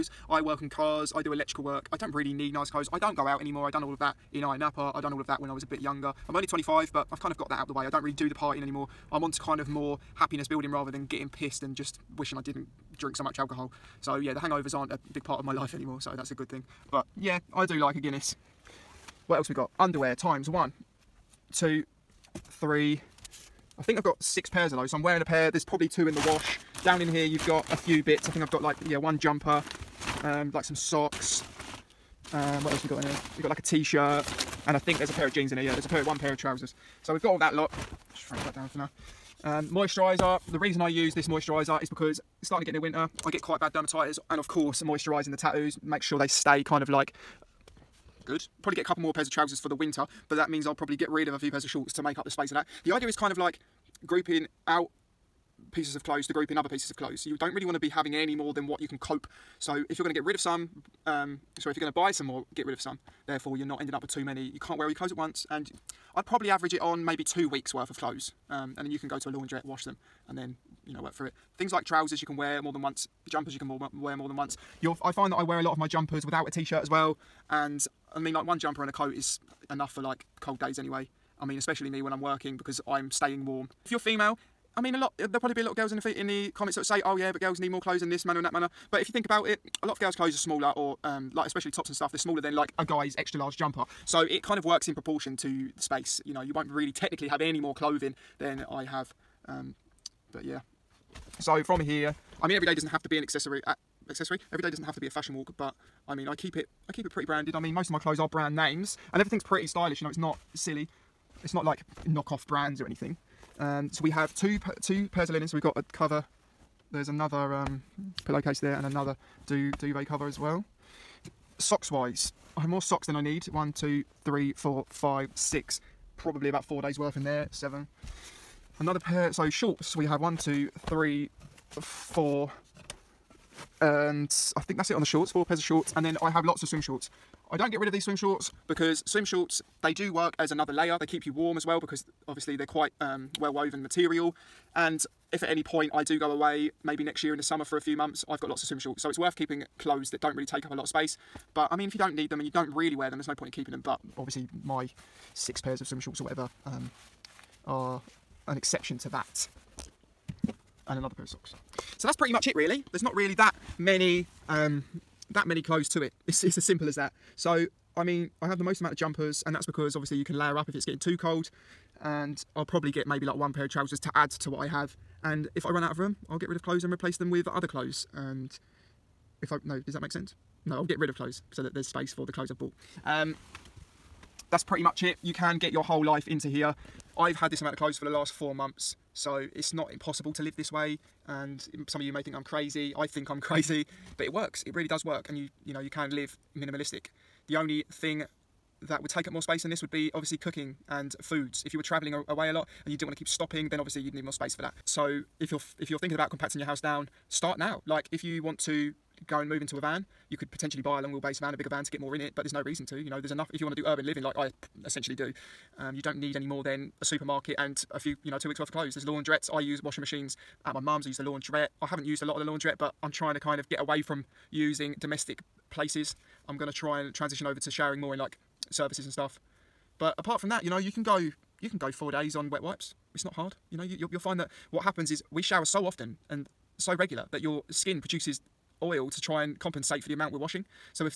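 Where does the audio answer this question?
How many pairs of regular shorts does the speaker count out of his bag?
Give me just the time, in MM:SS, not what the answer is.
02:15.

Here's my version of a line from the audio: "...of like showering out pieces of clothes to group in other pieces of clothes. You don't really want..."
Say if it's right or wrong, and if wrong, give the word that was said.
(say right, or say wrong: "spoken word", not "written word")
wrong: "grouping", not "showering".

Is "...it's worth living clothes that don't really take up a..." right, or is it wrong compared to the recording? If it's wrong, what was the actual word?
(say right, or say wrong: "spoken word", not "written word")
wrong: "keeping", not "living".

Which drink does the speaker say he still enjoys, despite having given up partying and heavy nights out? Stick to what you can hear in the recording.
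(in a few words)
Guinness.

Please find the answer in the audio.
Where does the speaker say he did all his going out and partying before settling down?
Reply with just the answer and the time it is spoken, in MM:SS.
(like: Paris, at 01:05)
Ayia Napa, at 00:04.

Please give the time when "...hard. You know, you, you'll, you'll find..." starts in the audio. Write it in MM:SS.
03:53.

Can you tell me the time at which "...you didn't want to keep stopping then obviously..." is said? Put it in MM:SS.
03:22.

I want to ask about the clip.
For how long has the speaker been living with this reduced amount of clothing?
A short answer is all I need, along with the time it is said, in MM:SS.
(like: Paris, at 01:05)
4 months, at 03:08.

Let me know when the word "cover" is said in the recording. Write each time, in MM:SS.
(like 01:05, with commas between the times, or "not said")
01:55, 02:00.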